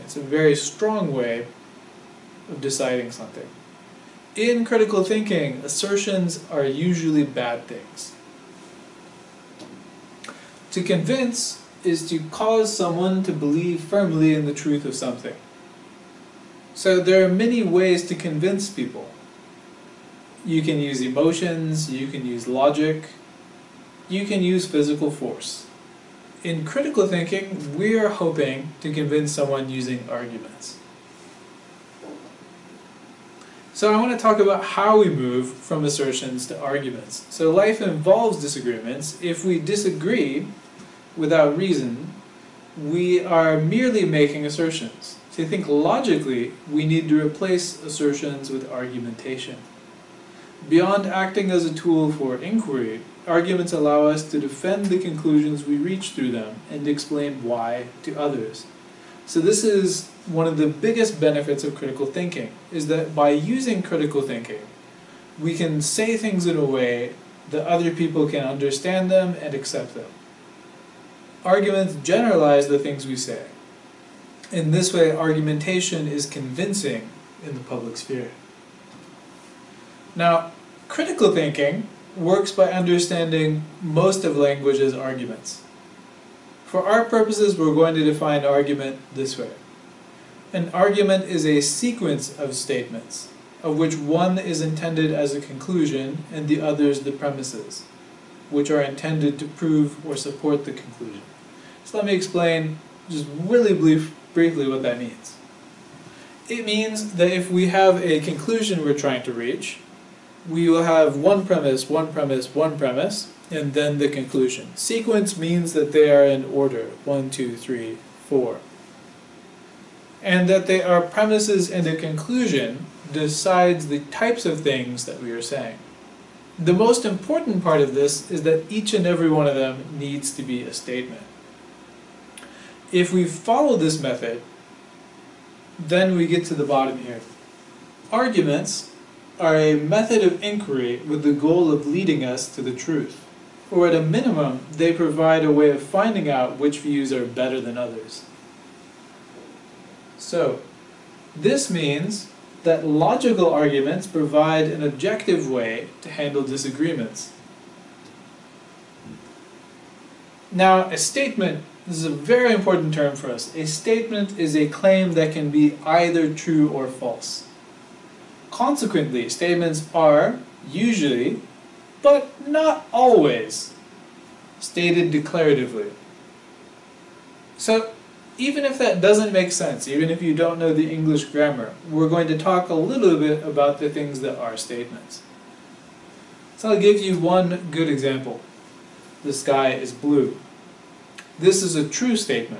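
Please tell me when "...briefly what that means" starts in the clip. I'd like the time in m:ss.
1:44.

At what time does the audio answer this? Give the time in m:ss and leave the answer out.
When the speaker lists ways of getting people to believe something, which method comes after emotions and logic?
0:24.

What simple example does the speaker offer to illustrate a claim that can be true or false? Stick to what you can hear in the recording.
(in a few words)
the sky is blue.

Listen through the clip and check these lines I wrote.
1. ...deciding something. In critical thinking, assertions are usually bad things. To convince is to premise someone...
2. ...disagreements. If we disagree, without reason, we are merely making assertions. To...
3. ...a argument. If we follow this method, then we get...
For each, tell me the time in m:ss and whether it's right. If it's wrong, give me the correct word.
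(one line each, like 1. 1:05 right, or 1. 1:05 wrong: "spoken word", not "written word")
1. 0:02 wrong: "cause", not "premise"
2. 0:38 right
3. 2:10 wrong: "statement", not "argument".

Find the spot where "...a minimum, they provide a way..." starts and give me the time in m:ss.
2:23.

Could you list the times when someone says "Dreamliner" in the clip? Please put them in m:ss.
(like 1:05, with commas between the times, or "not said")
not said.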